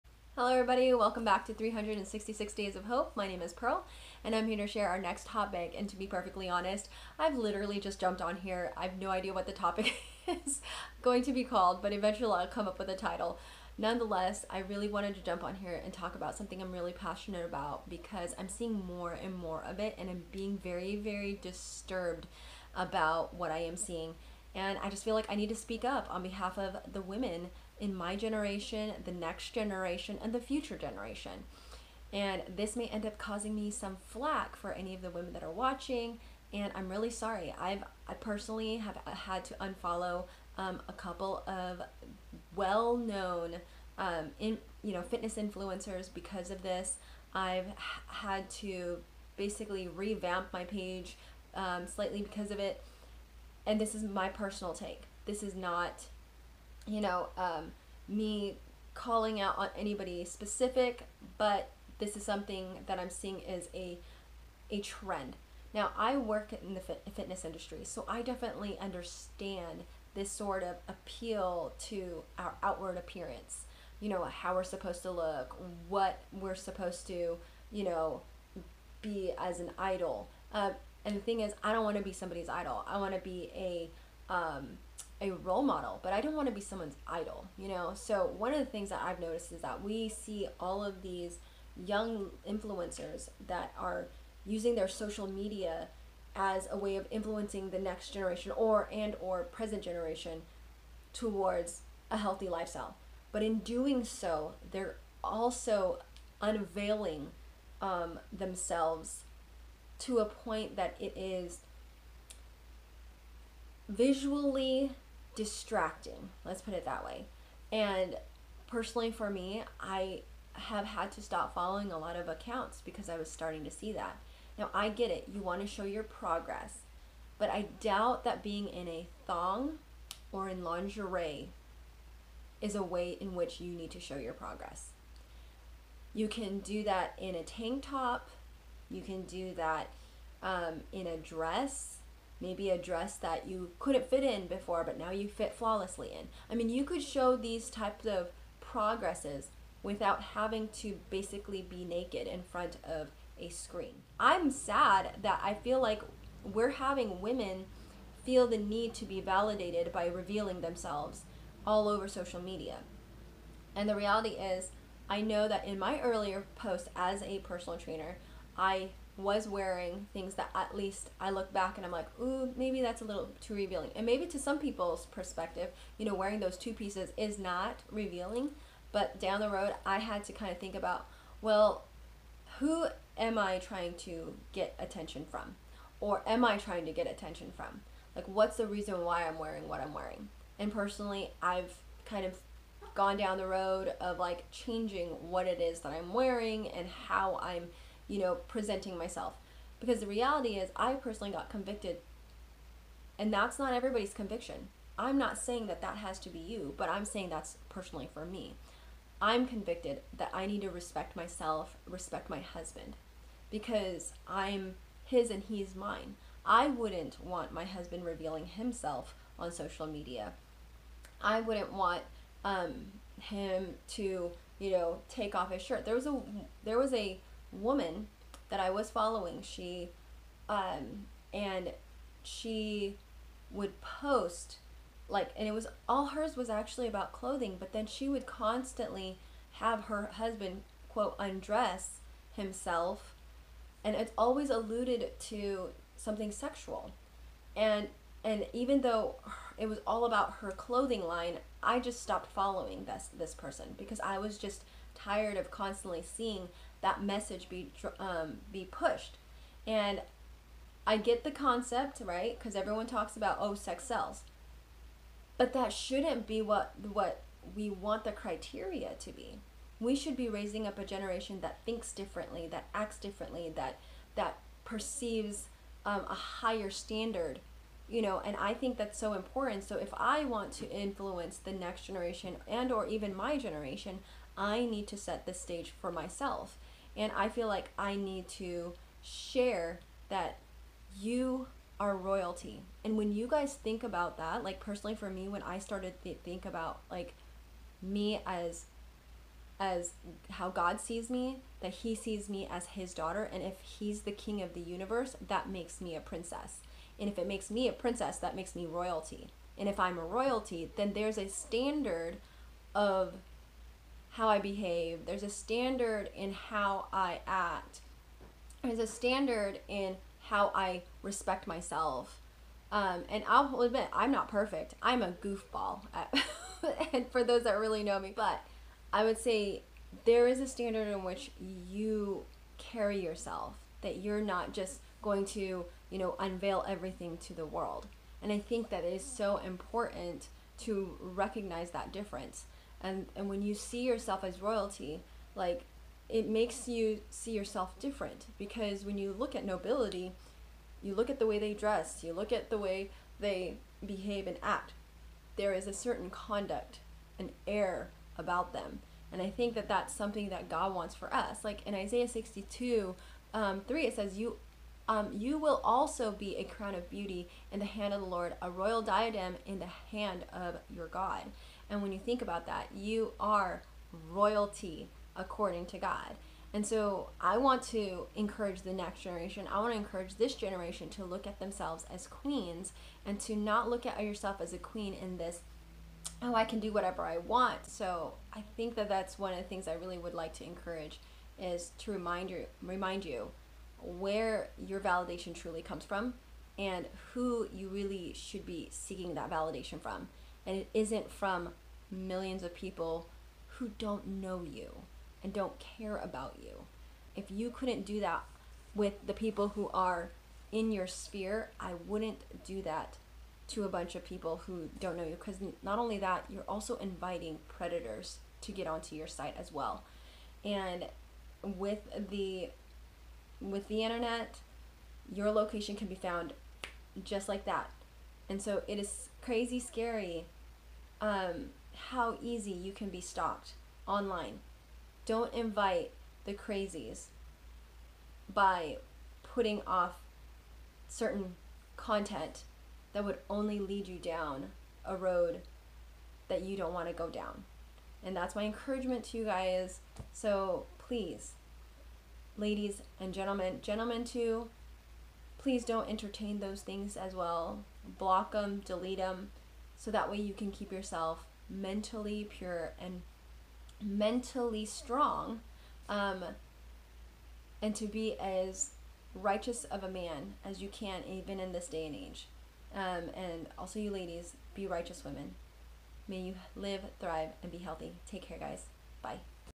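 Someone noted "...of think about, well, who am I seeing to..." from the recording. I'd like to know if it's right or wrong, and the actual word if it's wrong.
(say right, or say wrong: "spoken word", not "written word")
wrong: "trying", not "seeing".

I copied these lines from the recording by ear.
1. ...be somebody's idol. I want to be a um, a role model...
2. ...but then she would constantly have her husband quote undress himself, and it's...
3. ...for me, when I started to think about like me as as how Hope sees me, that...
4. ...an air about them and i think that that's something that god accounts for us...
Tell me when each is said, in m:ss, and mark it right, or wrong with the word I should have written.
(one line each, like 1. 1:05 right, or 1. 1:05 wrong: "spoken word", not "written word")
1. 1:22 right
2. 3:57 right
3. 4:54 wrong: "God", not "Hope"
4. 5:57 wrong: "wants", not "accounts".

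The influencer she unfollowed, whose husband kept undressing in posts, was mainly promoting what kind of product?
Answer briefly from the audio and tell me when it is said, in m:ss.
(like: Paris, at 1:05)
Clothing line, at 4:10.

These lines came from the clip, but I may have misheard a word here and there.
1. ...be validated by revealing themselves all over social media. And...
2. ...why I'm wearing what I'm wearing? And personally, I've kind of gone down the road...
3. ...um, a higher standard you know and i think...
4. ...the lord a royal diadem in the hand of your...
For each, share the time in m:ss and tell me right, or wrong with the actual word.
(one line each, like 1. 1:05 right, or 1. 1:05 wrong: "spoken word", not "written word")
1. 2:39 right
2. 3:09 right
3. 4:35 right
4. 6:08 right.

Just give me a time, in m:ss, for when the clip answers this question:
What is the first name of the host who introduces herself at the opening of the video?
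0:03.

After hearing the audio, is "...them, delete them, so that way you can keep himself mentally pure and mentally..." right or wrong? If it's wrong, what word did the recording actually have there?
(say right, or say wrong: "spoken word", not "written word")
wrong: "yourself", not "himself".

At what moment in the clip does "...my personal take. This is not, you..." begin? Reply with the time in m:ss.
0:54.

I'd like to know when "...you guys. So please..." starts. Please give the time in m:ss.
7:29.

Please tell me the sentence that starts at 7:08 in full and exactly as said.
And so it is crazy scary um, how easy you can be stalked online.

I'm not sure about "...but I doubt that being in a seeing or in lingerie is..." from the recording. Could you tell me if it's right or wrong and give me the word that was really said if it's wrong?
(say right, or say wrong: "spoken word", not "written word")
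wrong: "thong", not "seeing".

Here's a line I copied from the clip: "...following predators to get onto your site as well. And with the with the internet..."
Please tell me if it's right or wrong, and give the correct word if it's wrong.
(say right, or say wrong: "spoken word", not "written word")
wrong: "inviting", not "following".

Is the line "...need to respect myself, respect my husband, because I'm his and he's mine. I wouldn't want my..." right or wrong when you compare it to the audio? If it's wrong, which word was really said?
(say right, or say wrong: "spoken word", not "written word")
right.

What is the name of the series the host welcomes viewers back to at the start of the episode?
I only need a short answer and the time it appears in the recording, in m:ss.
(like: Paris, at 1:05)
366 Days of Hope, at 0:01.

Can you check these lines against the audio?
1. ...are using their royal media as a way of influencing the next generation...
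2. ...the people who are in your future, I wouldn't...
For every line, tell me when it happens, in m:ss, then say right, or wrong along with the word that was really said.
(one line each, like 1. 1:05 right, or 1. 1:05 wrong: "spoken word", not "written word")
1. 1:33 wrong: "social", not "royal"
2. 6:49 wrong: "sphere", not "future".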